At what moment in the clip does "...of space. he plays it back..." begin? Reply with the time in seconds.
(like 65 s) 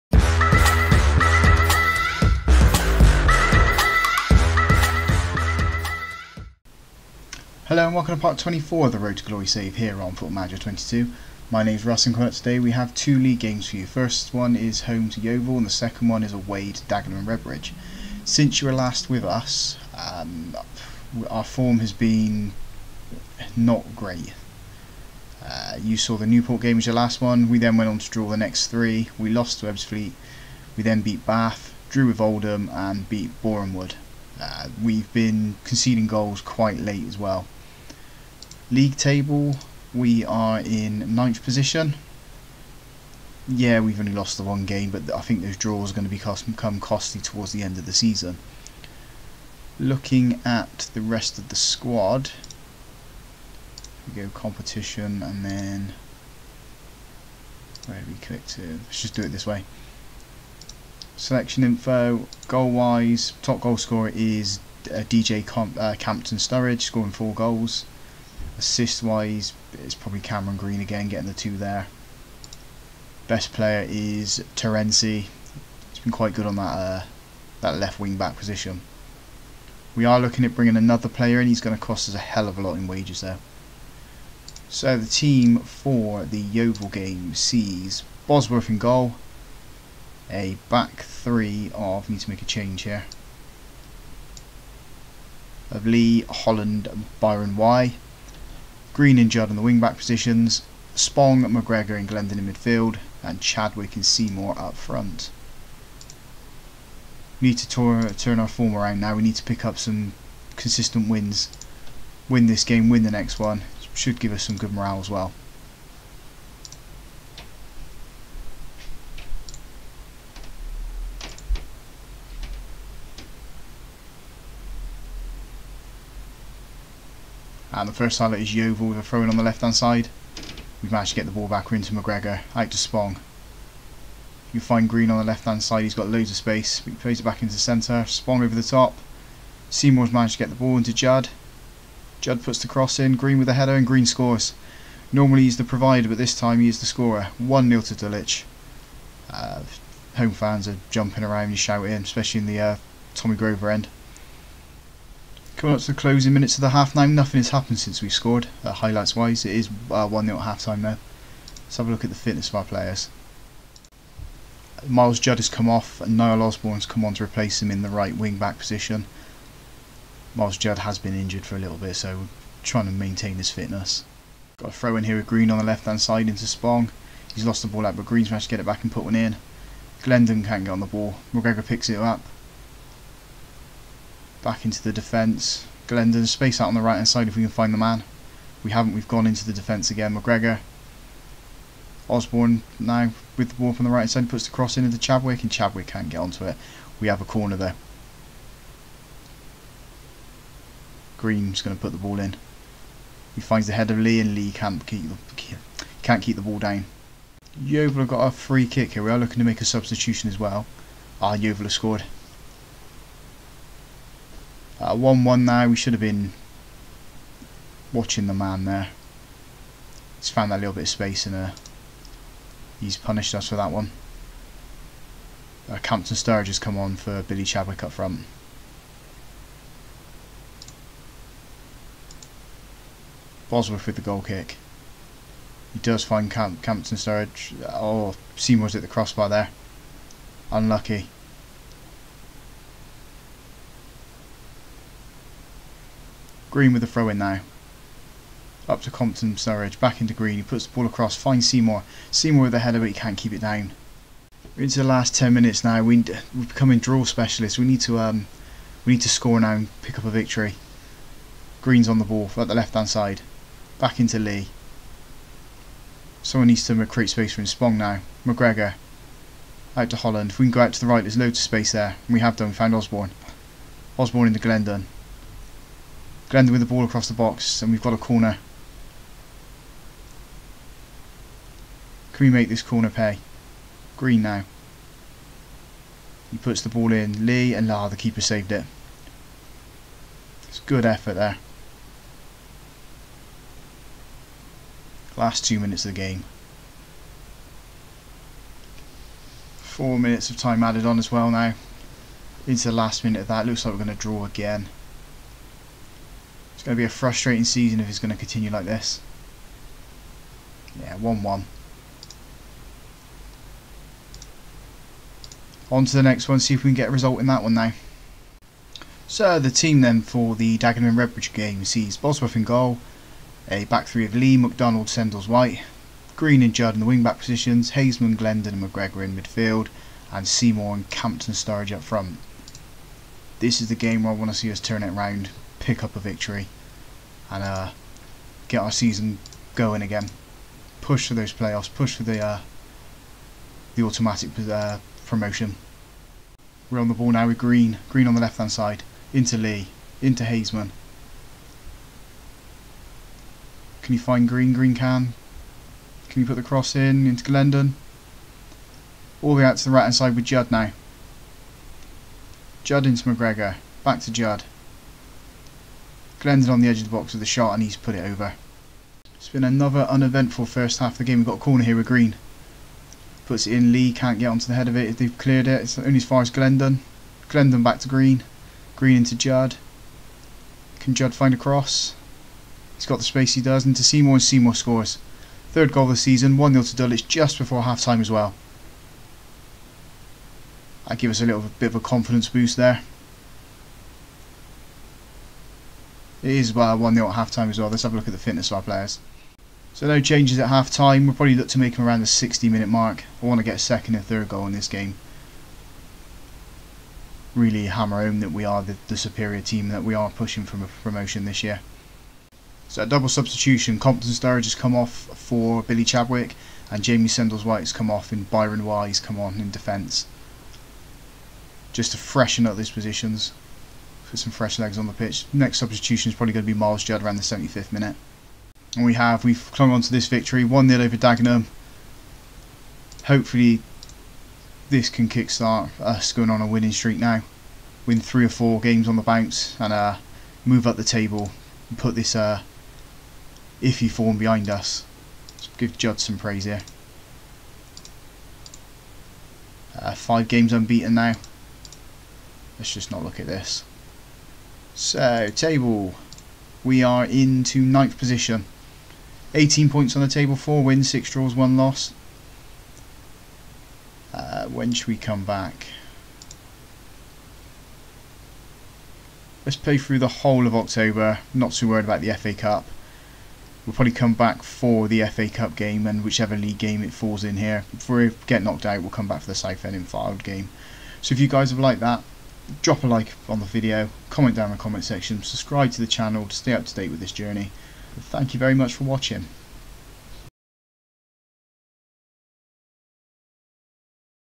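136 s.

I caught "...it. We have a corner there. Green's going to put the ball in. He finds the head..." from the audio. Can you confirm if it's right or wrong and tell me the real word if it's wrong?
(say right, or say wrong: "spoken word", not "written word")
right.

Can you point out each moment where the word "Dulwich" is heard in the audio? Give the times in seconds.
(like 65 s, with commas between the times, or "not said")
147 s, 386 s.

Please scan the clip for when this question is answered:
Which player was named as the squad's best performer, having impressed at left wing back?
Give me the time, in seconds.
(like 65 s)
74 s.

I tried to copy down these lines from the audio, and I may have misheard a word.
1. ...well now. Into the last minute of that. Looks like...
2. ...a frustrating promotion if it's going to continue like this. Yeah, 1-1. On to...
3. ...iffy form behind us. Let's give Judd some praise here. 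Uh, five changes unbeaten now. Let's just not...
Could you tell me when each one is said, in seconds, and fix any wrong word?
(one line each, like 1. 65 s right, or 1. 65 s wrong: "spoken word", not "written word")
1. 301 s right
2. 306 s wrong: "season", not "promotion"
3. 443 s wrong: "games", not "changes".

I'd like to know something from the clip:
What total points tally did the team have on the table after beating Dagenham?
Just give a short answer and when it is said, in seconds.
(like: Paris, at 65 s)
18, at 459 s.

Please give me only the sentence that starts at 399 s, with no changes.
So, no changes at half time.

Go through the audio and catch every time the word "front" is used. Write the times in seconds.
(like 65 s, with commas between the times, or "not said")
104 s, 227 s, 331 s.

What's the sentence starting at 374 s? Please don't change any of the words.
they've cleared it, it's only as far as Glendon.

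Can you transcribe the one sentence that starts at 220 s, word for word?
He's found that little bit of space in there.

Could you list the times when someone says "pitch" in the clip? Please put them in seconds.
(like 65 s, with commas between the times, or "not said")
424 s.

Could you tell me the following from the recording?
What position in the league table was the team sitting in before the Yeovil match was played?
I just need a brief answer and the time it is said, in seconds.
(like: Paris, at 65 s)
9th, at 41 s.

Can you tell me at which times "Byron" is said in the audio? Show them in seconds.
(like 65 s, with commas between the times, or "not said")
97 s, 418 s.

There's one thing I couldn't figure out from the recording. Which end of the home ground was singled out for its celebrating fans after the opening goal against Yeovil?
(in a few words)
Tommy Grover end.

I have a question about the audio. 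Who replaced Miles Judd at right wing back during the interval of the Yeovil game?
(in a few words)
Niall Osborne.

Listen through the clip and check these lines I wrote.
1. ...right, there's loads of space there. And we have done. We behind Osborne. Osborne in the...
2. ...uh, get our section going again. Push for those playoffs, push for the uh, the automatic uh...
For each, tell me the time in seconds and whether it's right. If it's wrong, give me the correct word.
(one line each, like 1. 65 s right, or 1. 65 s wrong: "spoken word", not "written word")
1. 270 s wrong: "found", not "behind"
2. 337 s wrong: "season", not "section".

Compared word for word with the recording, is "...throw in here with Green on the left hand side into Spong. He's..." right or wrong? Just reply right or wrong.
right.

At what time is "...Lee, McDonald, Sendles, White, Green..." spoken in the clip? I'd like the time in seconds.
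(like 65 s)
324 s.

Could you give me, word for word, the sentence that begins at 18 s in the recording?
Since you were last with us, um, our form has been not great.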